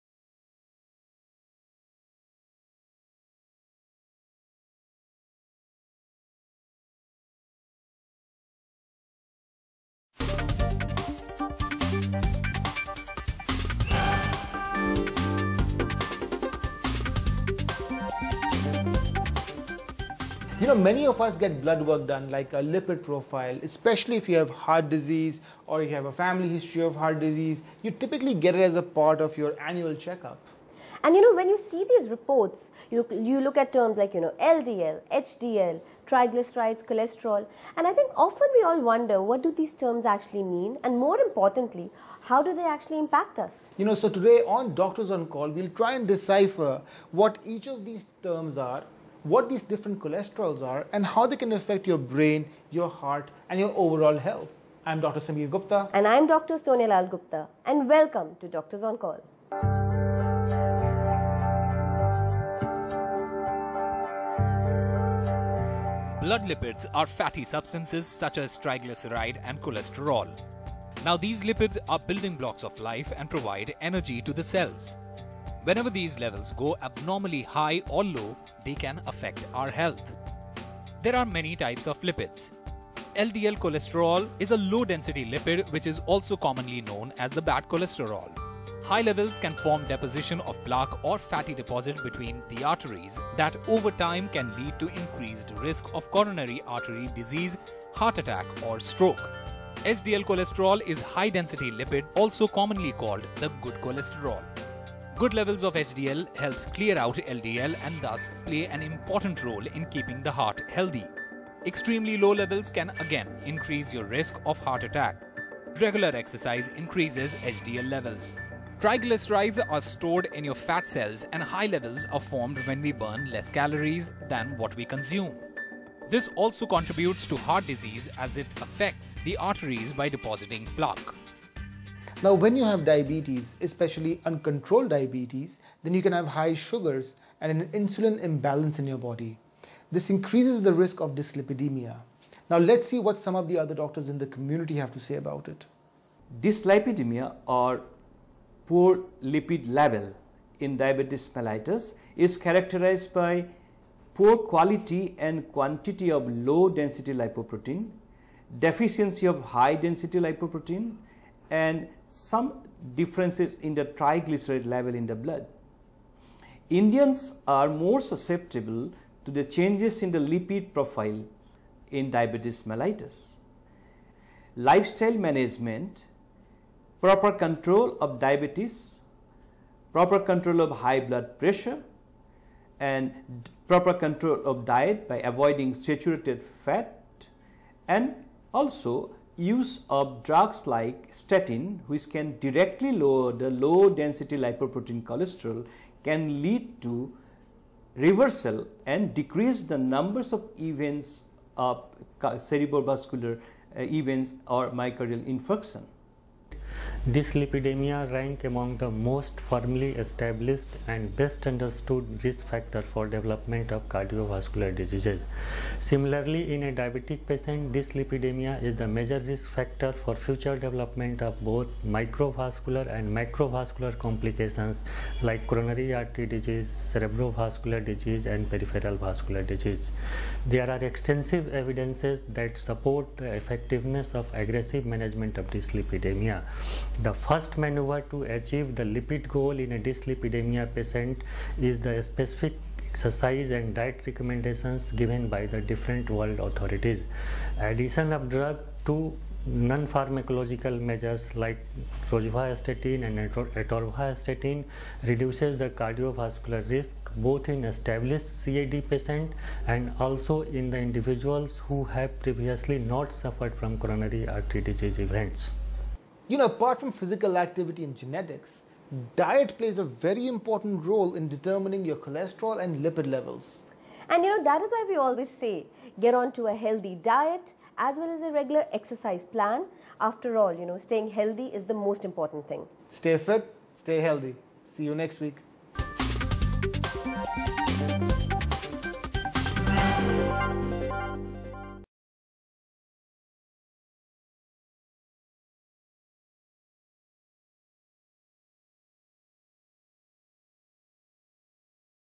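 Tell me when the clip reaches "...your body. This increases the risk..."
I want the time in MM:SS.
02:18.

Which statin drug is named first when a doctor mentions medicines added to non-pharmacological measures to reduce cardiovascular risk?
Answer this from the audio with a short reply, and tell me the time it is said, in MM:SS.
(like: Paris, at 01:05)
rosuvastatin, at 04:12.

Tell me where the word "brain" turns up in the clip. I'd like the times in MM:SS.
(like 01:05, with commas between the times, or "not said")
00:51.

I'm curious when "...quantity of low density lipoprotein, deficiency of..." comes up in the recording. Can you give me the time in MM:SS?
02:35.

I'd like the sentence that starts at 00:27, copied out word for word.
You typically get it as a part of your annual checkup.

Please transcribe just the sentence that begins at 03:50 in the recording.
There are extensive evidences that support the effectiveness of aggressive management of dyslipidemia.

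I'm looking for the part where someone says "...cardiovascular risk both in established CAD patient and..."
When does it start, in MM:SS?
04:15.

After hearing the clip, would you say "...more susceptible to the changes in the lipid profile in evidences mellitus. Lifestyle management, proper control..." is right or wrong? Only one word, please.
wrong.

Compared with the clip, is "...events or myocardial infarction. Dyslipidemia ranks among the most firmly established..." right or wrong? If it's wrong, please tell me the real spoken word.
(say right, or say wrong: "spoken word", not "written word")
right.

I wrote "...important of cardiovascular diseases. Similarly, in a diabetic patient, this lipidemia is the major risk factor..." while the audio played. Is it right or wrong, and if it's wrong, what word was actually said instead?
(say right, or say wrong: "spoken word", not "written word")
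wrong: "development", not "important".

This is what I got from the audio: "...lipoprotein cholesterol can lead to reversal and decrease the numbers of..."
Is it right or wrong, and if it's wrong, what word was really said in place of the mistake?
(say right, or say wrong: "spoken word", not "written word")
right.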